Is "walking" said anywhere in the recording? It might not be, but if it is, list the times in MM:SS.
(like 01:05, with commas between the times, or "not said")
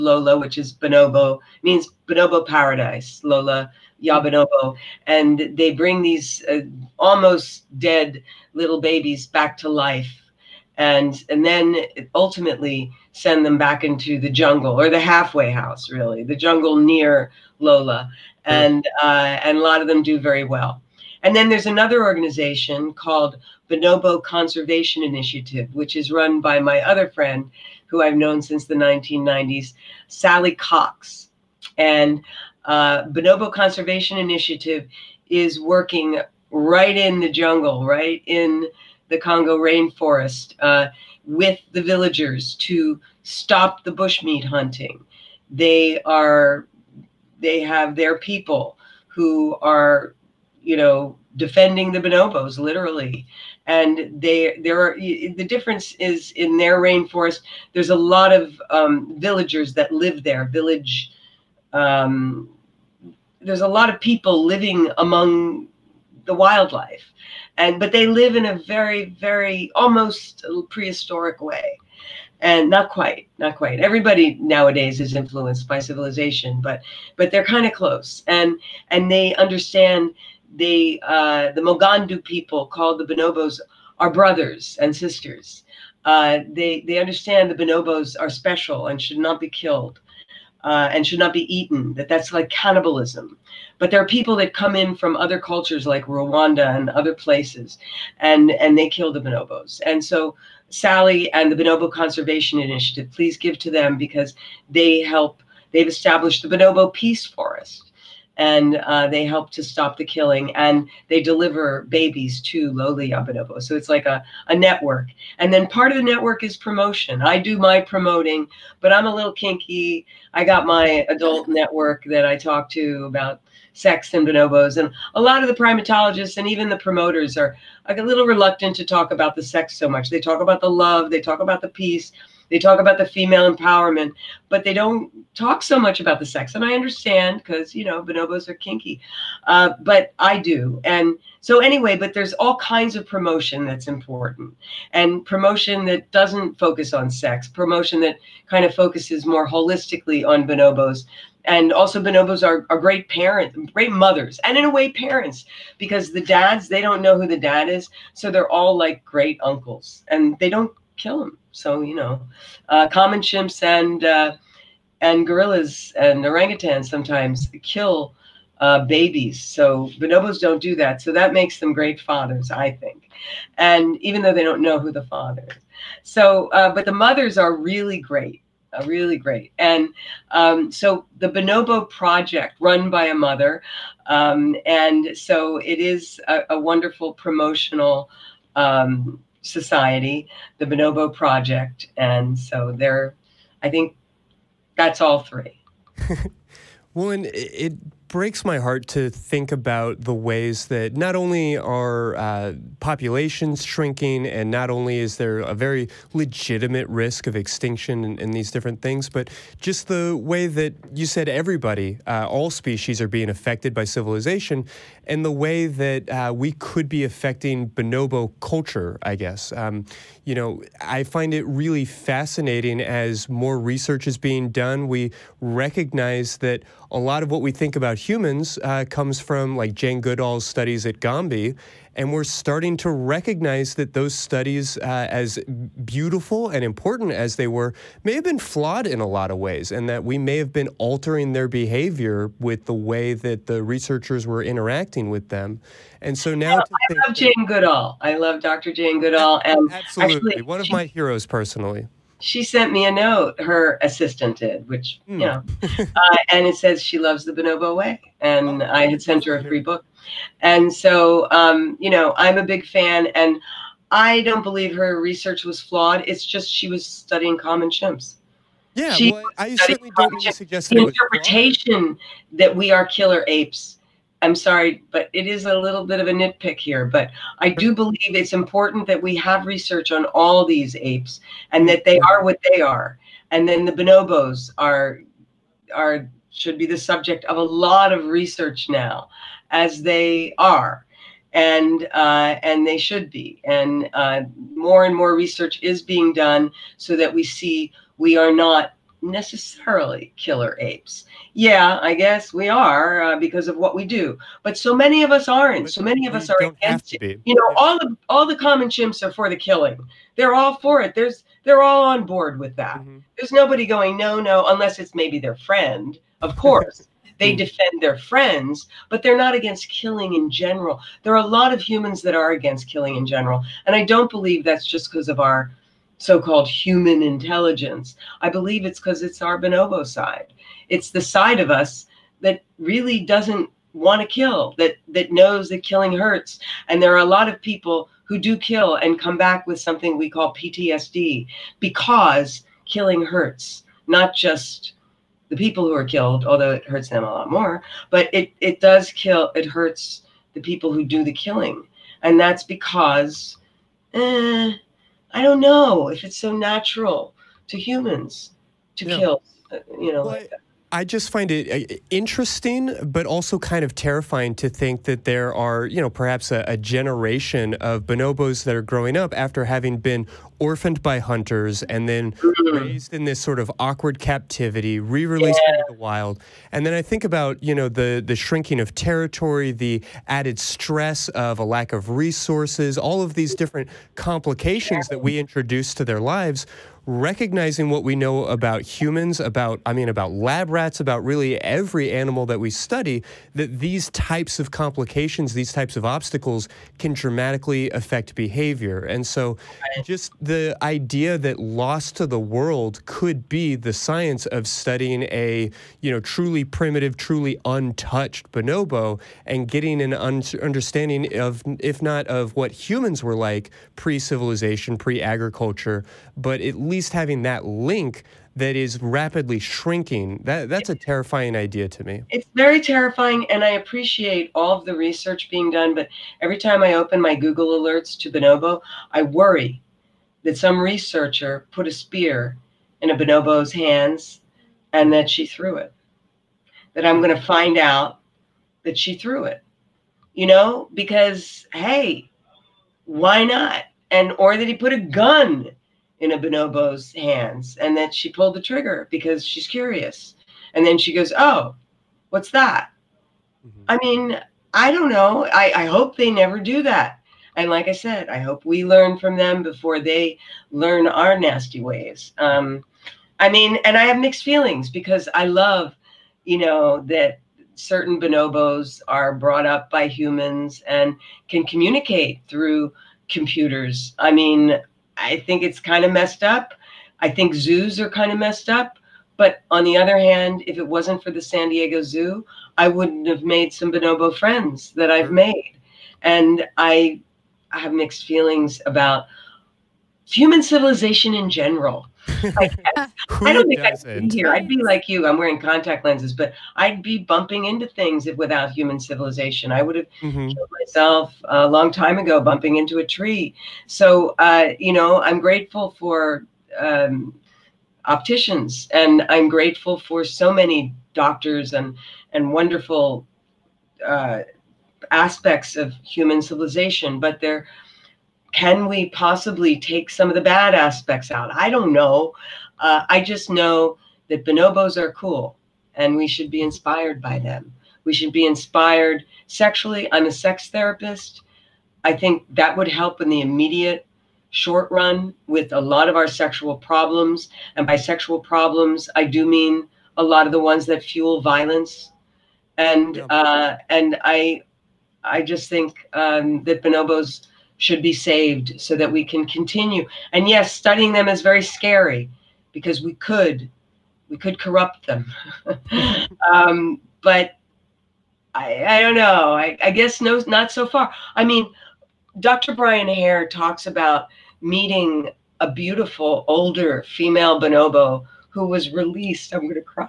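not said.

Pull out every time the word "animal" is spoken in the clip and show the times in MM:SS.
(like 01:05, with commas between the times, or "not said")
06:31.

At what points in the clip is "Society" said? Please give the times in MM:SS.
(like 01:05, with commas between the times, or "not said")
03:09.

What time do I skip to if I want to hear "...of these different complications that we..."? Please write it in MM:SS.
06:23.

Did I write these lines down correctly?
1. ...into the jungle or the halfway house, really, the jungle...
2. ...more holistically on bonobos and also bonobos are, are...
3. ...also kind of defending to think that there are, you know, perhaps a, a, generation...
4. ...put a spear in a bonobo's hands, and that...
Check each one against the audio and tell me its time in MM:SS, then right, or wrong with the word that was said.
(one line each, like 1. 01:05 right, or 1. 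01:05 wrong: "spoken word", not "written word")
1. 00:13 right
2. 02:29 right
3. 06:03 wrong: "terrifying", not "defending"
4. 07:11 right.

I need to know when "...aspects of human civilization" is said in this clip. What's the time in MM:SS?
08:34.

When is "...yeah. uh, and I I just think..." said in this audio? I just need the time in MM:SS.
09:02.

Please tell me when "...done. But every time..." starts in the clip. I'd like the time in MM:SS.
07:05.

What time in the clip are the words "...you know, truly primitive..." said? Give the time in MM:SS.
06:45.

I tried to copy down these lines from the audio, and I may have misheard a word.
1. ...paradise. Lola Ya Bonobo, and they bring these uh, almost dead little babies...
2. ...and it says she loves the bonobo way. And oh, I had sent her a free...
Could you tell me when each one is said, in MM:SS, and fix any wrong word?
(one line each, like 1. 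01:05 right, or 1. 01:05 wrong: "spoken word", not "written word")
1. 00:02 right
2. 04:16 right.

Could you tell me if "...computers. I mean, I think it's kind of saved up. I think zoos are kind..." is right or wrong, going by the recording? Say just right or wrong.
wrong.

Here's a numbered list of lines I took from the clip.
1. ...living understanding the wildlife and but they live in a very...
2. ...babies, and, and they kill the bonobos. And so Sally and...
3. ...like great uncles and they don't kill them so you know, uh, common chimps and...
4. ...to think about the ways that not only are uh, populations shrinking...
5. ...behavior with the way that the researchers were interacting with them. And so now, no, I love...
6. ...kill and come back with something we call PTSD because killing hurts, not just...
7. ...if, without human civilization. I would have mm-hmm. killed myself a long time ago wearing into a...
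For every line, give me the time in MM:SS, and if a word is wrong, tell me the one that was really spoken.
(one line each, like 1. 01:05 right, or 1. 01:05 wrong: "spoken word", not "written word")
1. 01:04 wrong: "among", not "understanding"
2. 01:37 wrong: "places", not "babies"
3. 02:38 right
4. 03:18 right
5. 04:01 right
6. 05:38 right
7. 08:18 wrong: "bumping", not "wearing".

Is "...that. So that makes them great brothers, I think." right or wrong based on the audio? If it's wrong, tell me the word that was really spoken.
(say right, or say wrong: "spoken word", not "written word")
wrong: "fathers", not "brothers".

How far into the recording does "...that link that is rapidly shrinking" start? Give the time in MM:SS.
06:57.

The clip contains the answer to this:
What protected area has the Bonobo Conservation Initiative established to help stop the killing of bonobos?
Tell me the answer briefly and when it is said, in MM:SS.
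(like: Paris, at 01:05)
Bonobo Peace Forest, at 01:46.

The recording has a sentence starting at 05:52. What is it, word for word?
And that's because eh, I don't know if it's so natural to humans to yeah.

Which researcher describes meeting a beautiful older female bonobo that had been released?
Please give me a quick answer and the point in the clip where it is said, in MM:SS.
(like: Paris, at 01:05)
Brian Hare, at 09:22.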